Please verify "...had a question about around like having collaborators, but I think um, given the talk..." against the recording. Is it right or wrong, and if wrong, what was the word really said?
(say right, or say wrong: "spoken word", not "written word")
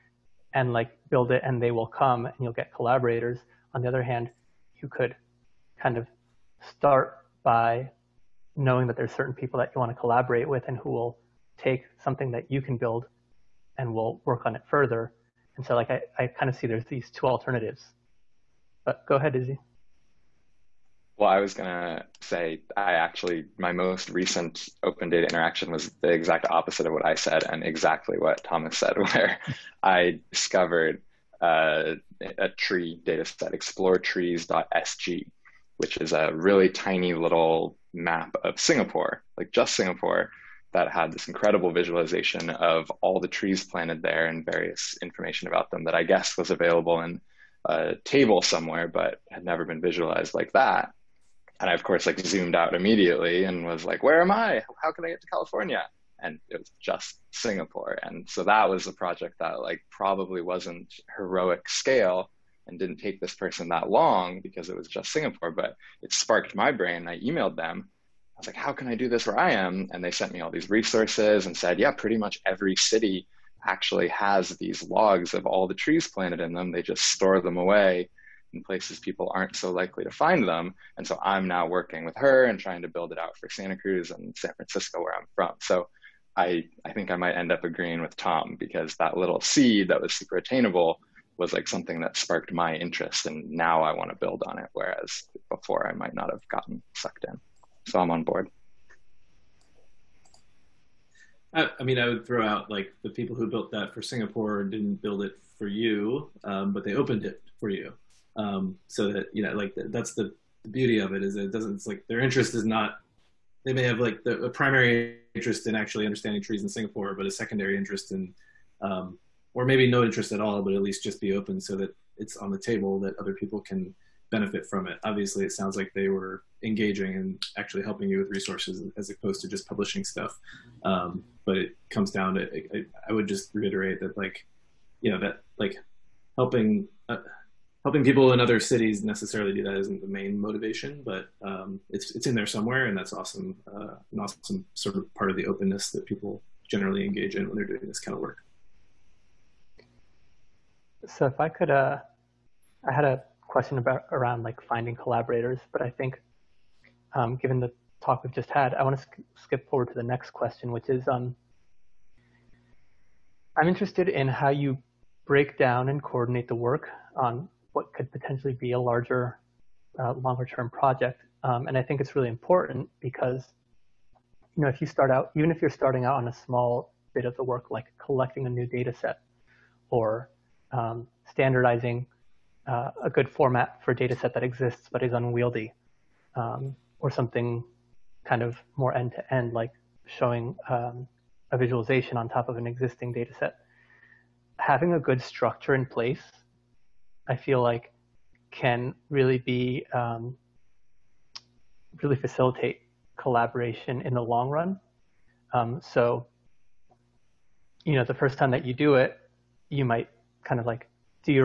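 wrong: "finding", not "having".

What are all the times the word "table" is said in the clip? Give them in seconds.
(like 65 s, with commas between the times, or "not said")
48 s, 122 s.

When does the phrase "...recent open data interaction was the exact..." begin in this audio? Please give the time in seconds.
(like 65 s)
24 s.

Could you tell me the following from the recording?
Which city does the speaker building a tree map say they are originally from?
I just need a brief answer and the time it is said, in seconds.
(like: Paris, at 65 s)
San Francisco, at 84 s.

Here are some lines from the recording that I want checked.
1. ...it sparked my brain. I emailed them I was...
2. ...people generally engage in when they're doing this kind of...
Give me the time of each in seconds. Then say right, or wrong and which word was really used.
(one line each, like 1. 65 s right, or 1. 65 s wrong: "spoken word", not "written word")
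1. 66 s right
2. 146 s right.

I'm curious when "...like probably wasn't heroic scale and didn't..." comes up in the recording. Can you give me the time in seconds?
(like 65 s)
59 s.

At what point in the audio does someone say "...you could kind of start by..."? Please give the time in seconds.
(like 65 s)
4 s.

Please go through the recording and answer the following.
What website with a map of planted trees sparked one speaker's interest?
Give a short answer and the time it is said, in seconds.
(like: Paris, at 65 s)
exploretrees.sg, at 33 s.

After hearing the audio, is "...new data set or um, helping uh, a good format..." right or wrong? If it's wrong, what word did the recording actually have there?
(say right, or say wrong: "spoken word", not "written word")
wrong: "standardizing", not "helping".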